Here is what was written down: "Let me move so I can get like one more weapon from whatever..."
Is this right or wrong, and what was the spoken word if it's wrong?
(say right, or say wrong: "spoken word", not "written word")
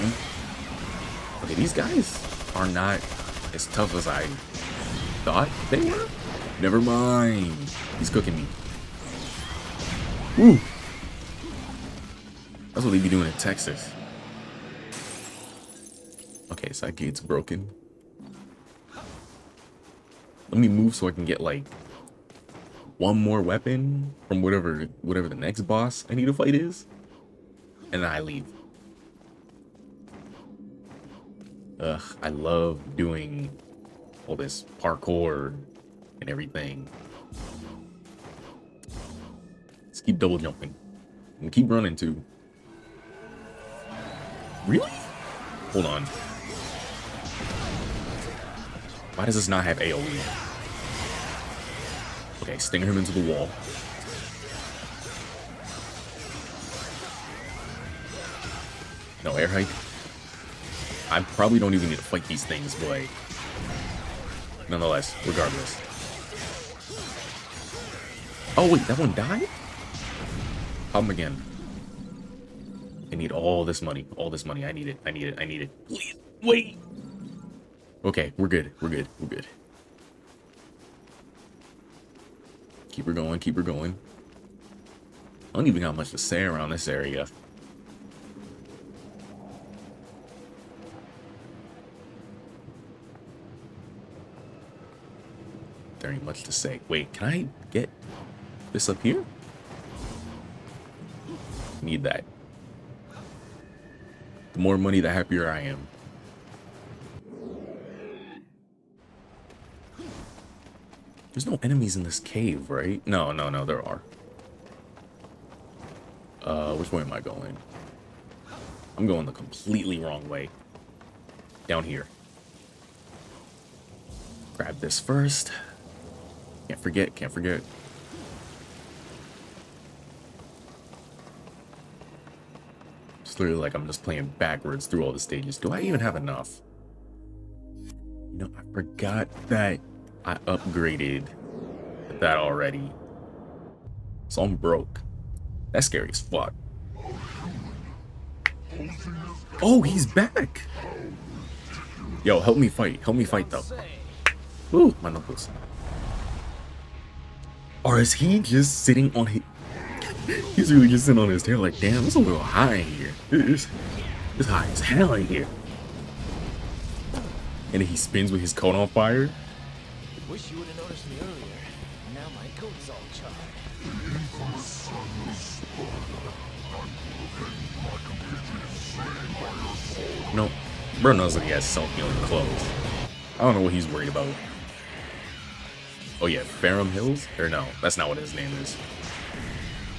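right.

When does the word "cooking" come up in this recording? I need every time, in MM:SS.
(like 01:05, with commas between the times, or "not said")
00:08.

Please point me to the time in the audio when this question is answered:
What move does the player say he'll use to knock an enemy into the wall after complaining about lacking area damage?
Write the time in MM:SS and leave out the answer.
00:52.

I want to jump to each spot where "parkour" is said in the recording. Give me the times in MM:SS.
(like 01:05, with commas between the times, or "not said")
00:34.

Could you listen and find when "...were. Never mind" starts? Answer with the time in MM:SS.
00:05.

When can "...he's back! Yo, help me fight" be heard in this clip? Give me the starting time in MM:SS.
02:29.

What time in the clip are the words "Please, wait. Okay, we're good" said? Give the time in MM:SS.
01:15.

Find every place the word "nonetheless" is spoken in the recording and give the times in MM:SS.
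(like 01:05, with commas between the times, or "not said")
01:04.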